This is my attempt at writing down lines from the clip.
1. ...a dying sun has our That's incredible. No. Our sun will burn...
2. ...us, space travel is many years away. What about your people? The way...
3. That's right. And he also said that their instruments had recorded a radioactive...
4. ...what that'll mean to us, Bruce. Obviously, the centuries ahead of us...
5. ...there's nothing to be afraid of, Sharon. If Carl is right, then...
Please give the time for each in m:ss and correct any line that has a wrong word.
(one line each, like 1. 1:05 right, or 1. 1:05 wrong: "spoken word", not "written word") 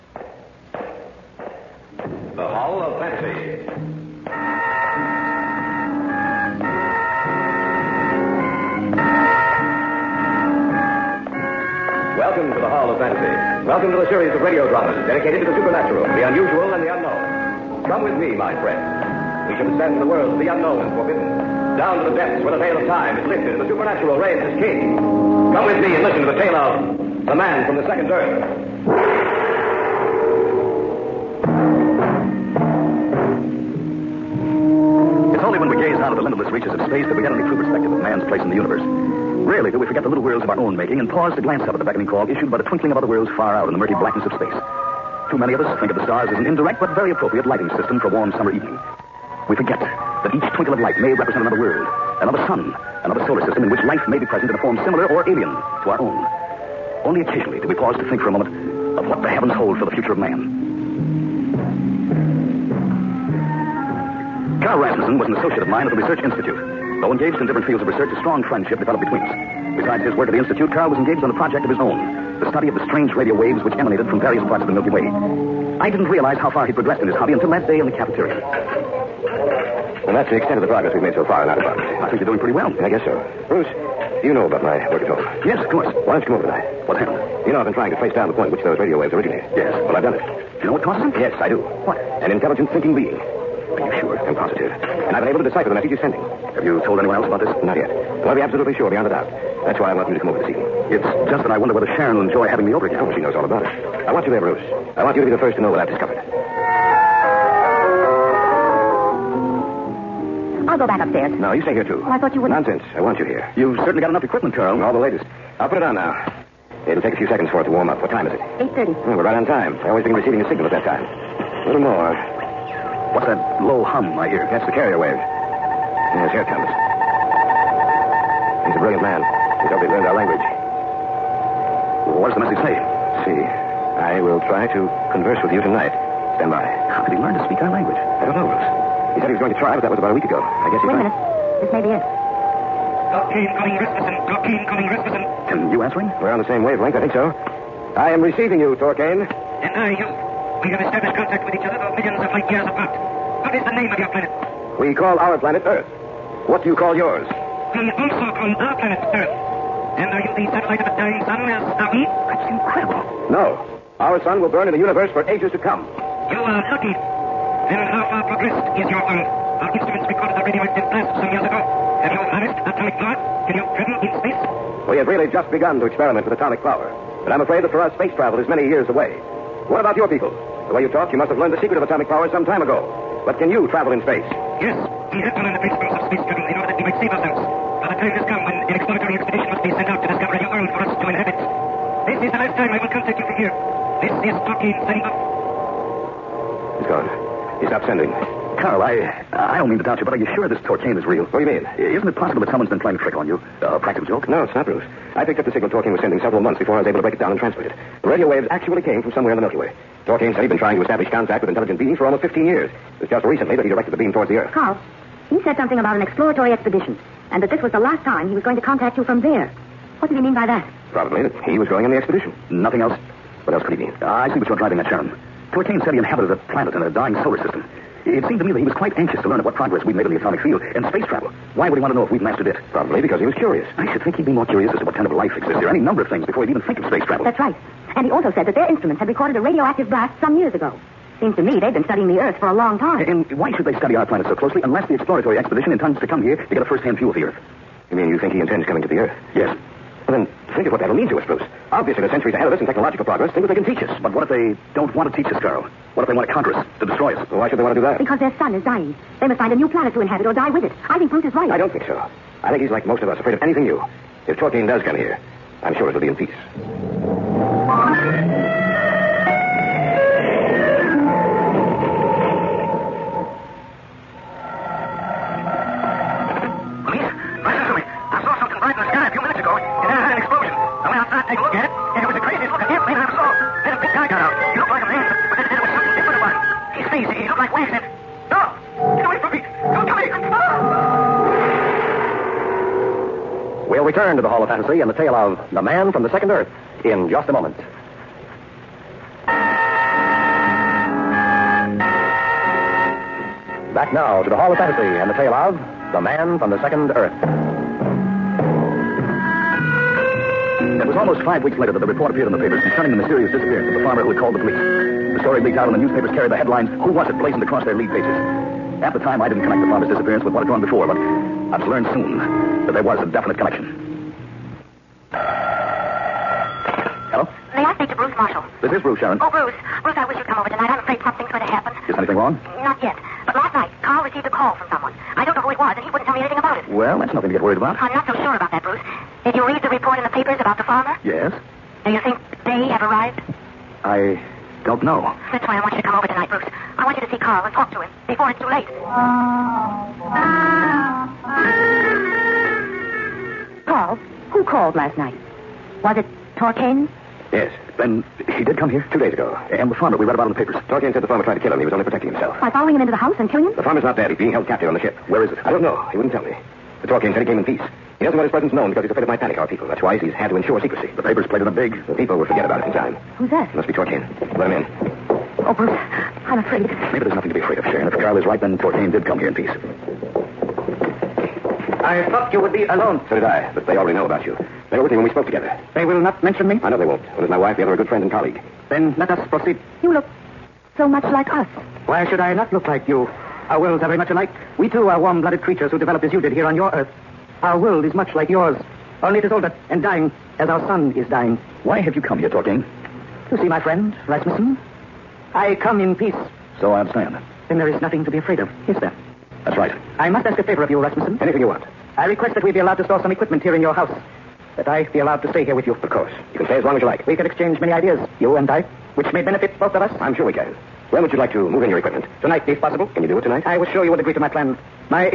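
1. 2:40 right
2. 2:57 right
3. 3:57 right
4. 4:10 right
5. 6:17 right.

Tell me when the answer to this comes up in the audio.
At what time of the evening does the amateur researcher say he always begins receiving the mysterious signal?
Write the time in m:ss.
1:58.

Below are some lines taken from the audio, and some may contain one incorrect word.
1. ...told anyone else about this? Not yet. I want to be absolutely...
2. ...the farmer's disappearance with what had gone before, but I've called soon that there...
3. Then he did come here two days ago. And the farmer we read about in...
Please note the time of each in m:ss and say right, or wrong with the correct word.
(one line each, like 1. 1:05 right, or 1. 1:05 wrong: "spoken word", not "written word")
1. 1:36 right
2. 5:19 wrong: "learned", not "called"
3. 5:57 right.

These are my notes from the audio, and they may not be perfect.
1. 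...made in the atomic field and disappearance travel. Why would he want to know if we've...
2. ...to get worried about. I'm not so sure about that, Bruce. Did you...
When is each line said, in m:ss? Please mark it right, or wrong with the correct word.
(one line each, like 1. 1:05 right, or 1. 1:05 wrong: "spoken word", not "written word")
1. 3:49 wrong: "space", not "disappearance"
2. 5:37 right.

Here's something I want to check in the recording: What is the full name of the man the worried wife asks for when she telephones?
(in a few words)
Bruce Marshall.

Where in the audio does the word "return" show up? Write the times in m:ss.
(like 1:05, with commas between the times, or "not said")
4:53.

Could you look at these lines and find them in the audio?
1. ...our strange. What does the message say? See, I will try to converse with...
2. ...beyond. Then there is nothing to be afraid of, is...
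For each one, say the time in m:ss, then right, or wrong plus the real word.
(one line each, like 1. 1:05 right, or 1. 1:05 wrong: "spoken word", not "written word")
1. 2:10 wrong: "language", not "strange"
2. 6:46 wrong: "understand", not "beyond".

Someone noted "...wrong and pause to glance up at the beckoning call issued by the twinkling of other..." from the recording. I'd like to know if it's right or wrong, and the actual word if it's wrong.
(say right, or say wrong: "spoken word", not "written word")
wrong: "making", not "wrong".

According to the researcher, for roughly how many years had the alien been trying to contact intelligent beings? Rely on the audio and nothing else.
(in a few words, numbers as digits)
15 years.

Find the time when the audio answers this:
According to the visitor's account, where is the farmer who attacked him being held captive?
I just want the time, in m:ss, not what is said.
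6:04.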